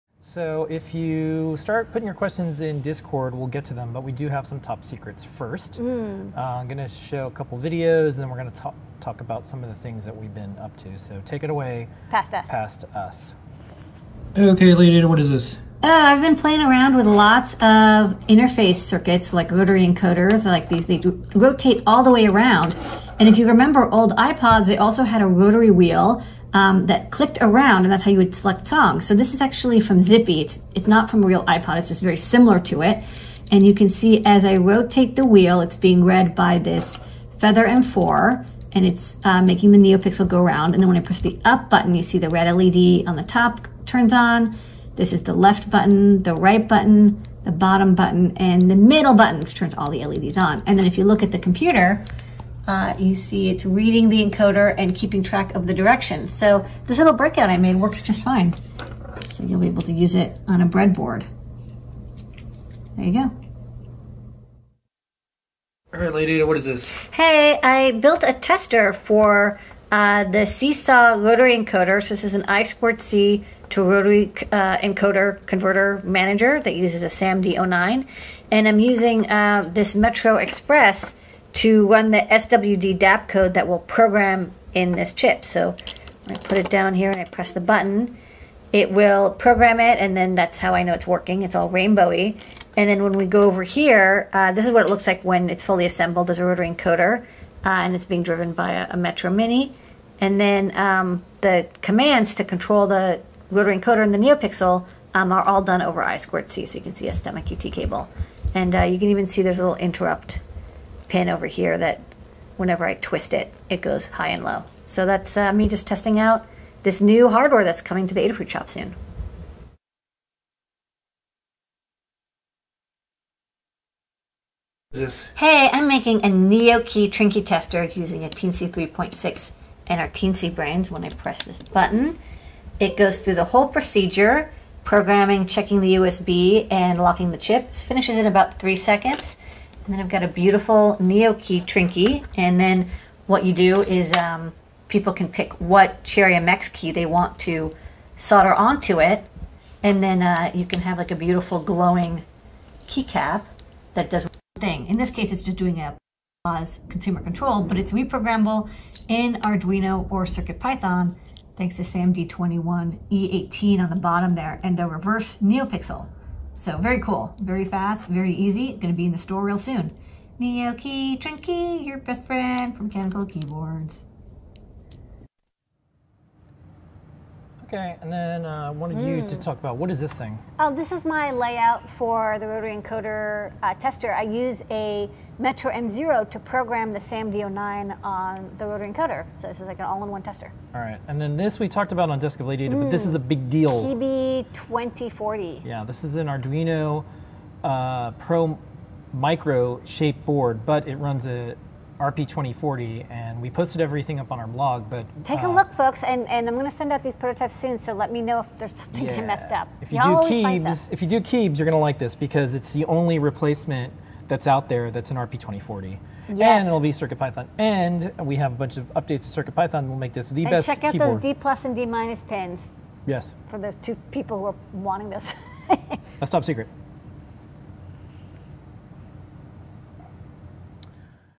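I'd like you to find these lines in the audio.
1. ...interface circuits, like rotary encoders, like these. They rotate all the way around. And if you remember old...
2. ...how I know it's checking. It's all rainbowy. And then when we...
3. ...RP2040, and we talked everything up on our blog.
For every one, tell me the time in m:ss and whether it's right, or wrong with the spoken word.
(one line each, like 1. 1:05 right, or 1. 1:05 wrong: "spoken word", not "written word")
1. 0:18 right
2. 1:30 wrong: "working", not "checking"
3. 3:22 wrong: "posted", not "talked".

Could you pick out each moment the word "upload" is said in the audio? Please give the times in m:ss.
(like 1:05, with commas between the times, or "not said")
not said.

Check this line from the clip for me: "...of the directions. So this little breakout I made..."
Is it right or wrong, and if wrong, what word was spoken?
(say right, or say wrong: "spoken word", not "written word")
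right.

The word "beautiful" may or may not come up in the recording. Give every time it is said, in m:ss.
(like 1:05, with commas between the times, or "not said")
2:20, 2:31.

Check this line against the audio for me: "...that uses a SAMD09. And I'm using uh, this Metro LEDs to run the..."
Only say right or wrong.
wrong.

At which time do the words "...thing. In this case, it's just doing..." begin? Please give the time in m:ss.
2:34.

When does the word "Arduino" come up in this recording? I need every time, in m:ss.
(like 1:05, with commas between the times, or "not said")
2:39, 3:16.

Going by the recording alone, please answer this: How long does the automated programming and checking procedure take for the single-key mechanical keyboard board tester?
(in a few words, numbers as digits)
About three seconds.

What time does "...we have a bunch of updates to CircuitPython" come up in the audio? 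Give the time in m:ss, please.
3:38.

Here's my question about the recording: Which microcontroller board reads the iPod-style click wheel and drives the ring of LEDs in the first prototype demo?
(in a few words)
Feather M4.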